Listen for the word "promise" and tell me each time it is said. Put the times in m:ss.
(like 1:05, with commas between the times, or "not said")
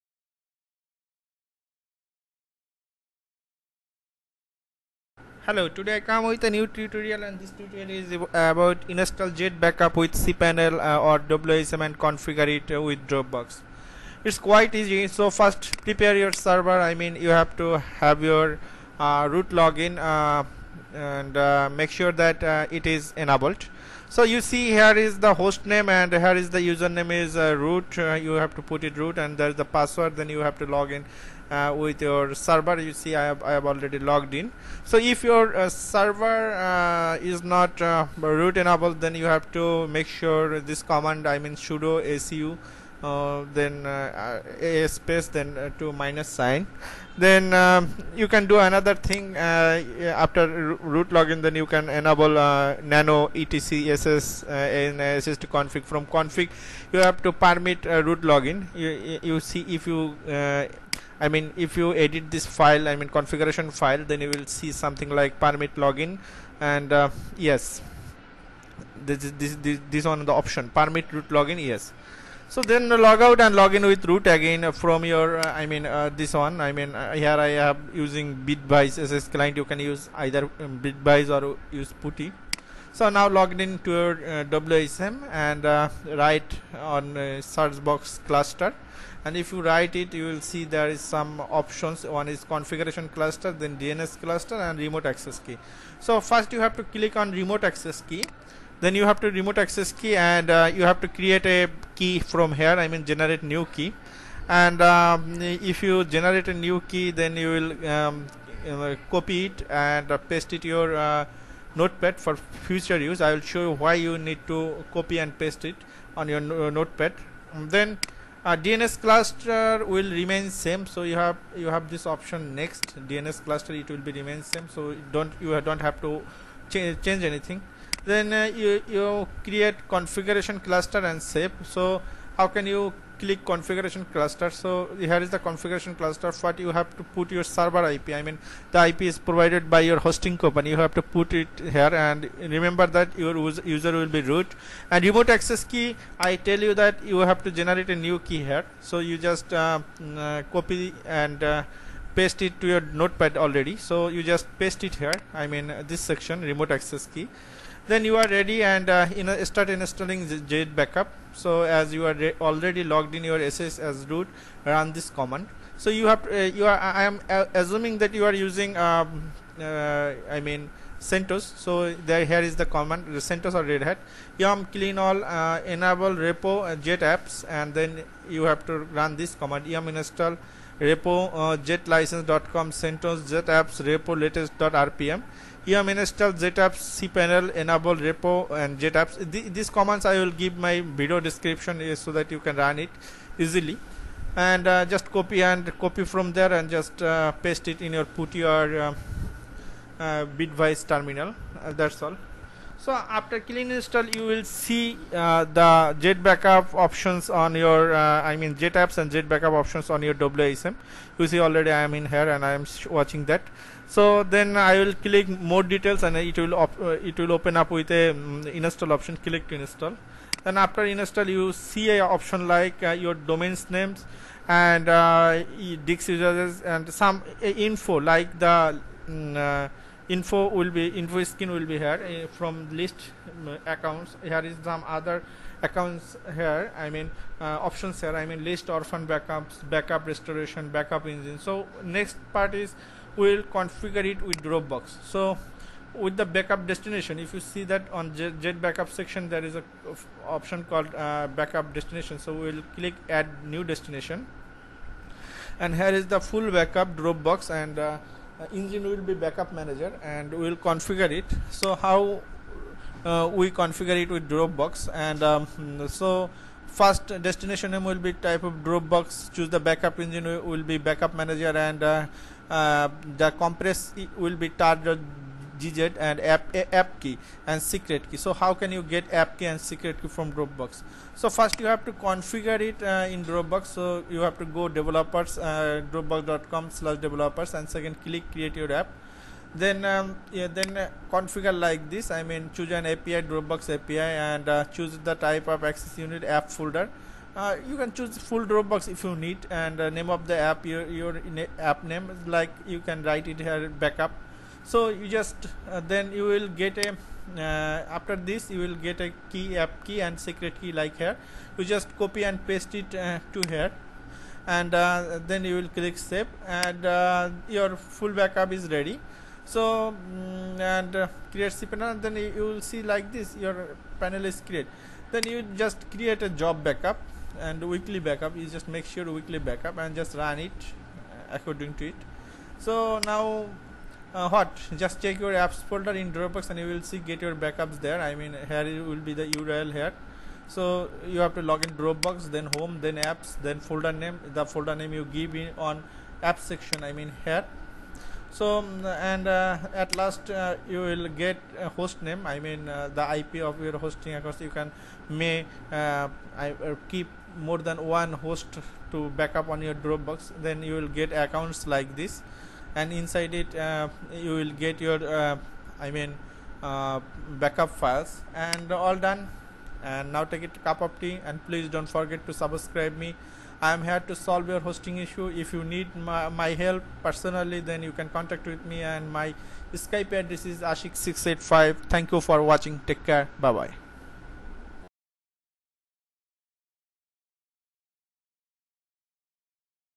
not said.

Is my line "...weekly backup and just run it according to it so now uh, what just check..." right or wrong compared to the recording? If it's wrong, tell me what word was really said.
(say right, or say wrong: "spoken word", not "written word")
right.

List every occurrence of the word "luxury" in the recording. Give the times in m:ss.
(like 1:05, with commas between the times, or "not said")
not said.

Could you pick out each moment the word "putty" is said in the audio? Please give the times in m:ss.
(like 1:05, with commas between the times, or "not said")
1:22.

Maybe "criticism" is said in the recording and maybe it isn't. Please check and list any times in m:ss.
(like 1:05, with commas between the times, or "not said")
not said.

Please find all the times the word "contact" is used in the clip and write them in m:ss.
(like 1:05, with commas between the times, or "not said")
6:18.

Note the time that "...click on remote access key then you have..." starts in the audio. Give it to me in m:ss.
1:36.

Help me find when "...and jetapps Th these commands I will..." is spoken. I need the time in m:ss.
3:08.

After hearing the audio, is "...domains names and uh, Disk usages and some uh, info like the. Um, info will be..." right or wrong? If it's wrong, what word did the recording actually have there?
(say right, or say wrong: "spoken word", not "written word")
right.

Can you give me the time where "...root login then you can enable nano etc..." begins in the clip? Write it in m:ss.
0:50.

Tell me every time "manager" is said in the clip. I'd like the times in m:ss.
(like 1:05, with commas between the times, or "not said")
4:19, 4:31.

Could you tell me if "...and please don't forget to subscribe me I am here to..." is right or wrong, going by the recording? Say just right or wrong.
right.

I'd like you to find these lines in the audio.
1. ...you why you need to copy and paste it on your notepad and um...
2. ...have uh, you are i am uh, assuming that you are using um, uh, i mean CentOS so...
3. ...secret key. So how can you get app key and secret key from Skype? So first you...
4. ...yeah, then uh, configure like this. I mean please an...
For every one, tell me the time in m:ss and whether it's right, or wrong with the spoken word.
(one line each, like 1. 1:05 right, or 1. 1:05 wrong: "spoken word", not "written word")
1. 1:53 right
2. 2:46 right
3. 4:37 wrong: "Dropbox", not "Skype"
4. 4:50 wrong: "choose", not "please".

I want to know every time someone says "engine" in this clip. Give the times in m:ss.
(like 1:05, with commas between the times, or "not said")
4:01, 4:18, 4:29.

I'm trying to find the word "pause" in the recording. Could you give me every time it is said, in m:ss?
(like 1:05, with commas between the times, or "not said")
not said.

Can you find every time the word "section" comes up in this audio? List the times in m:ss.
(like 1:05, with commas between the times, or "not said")
2:36, 4:08, 5:46.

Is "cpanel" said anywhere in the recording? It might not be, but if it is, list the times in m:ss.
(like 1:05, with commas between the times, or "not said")
0:10, 3:06, 5:21.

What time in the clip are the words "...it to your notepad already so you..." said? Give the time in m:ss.
2:32.